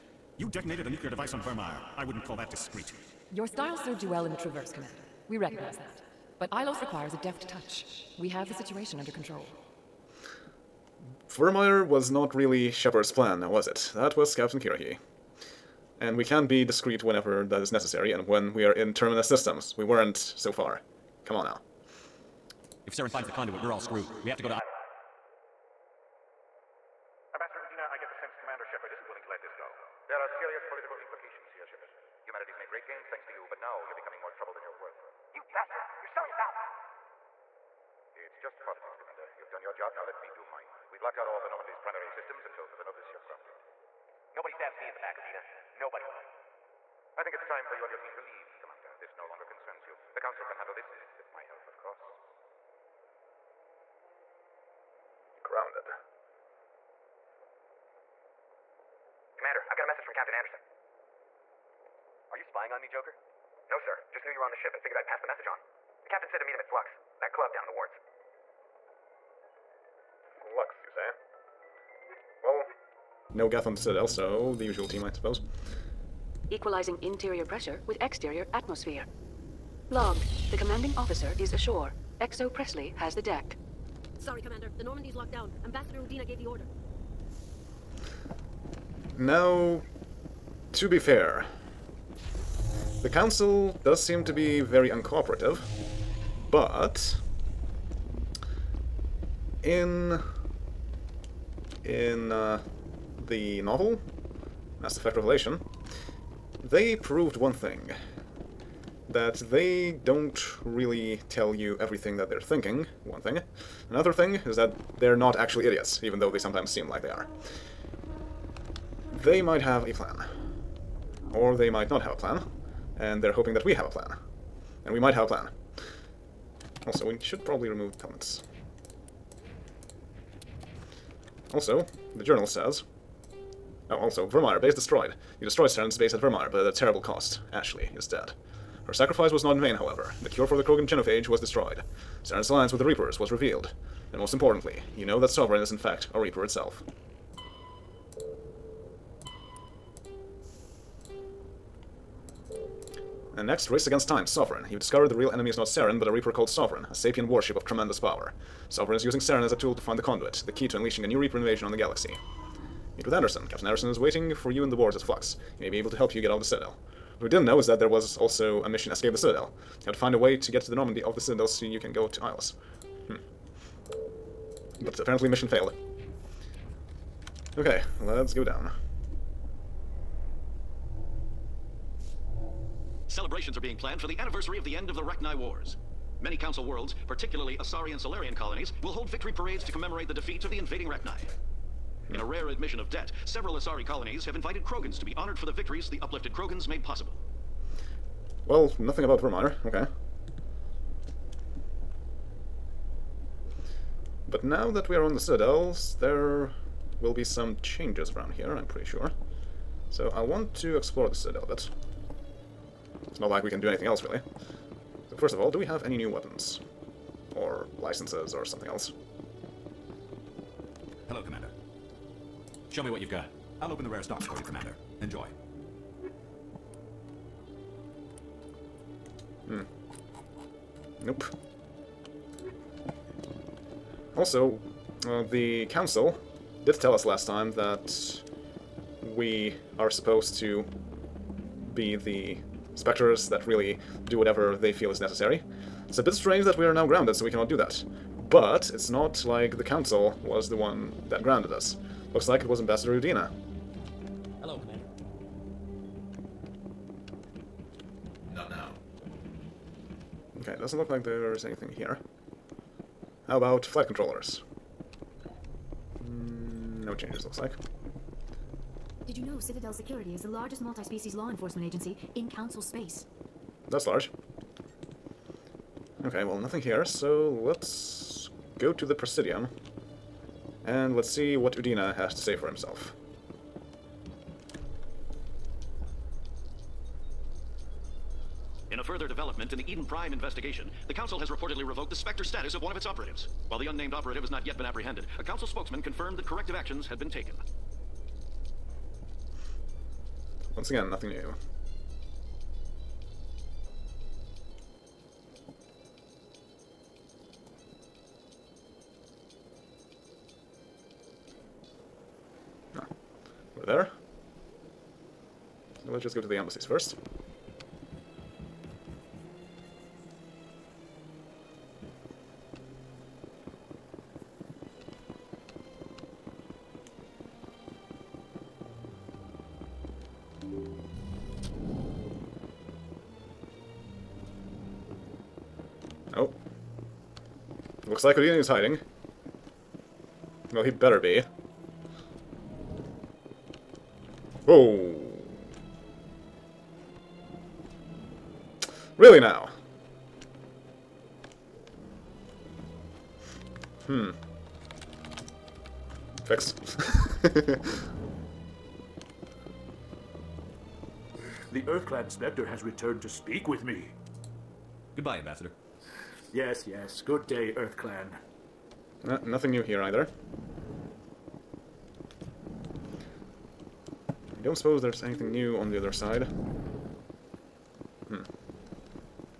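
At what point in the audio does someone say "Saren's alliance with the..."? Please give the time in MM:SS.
02:22.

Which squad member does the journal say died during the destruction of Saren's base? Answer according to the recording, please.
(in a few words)
Ashley.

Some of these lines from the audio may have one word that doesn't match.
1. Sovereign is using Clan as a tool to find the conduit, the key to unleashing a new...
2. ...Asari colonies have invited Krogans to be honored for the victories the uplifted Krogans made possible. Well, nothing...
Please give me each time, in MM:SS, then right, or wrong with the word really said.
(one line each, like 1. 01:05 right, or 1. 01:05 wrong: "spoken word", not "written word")
1. 02:38 wrong: "Saren", not "Clan"
2. 03:13 right.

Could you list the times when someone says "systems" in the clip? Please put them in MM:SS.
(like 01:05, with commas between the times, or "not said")
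00:19, 00:42.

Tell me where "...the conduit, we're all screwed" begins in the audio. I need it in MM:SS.
00:23.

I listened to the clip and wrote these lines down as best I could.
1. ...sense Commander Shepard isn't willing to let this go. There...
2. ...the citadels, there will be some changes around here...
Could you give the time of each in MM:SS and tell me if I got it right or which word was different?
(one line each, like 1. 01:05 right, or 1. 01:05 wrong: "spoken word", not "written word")
1. 00:28 right
2. 03:25 right.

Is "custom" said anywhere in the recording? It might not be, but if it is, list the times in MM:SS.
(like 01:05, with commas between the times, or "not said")
not said.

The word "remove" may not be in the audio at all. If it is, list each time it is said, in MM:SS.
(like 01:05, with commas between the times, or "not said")
02:07.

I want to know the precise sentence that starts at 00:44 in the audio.
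Nobody stabs me in the back, Udina.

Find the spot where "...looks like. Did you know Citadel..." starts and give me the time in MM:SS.
04:27.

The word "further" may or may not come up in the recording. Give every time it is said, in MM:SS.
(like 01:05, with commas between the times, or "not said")
00:42, 04:48.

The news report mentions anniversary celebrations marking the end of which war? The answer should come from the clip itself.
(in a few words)
Rachni Wars.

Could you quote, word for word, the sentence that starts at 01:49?
That they don't really tell you everything that they're thinking, one thing.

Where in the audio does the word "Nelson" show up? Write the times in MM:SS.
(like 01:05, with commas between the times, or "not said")
not said.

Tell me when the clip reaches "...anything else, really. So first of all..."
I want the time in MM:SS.
03:33.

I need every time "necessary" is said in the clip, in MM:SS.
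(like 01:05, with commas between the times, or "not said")
00:17, 04:04.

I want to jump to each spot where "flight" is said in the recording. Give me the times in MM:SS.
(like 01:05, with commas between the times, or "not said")
04:23.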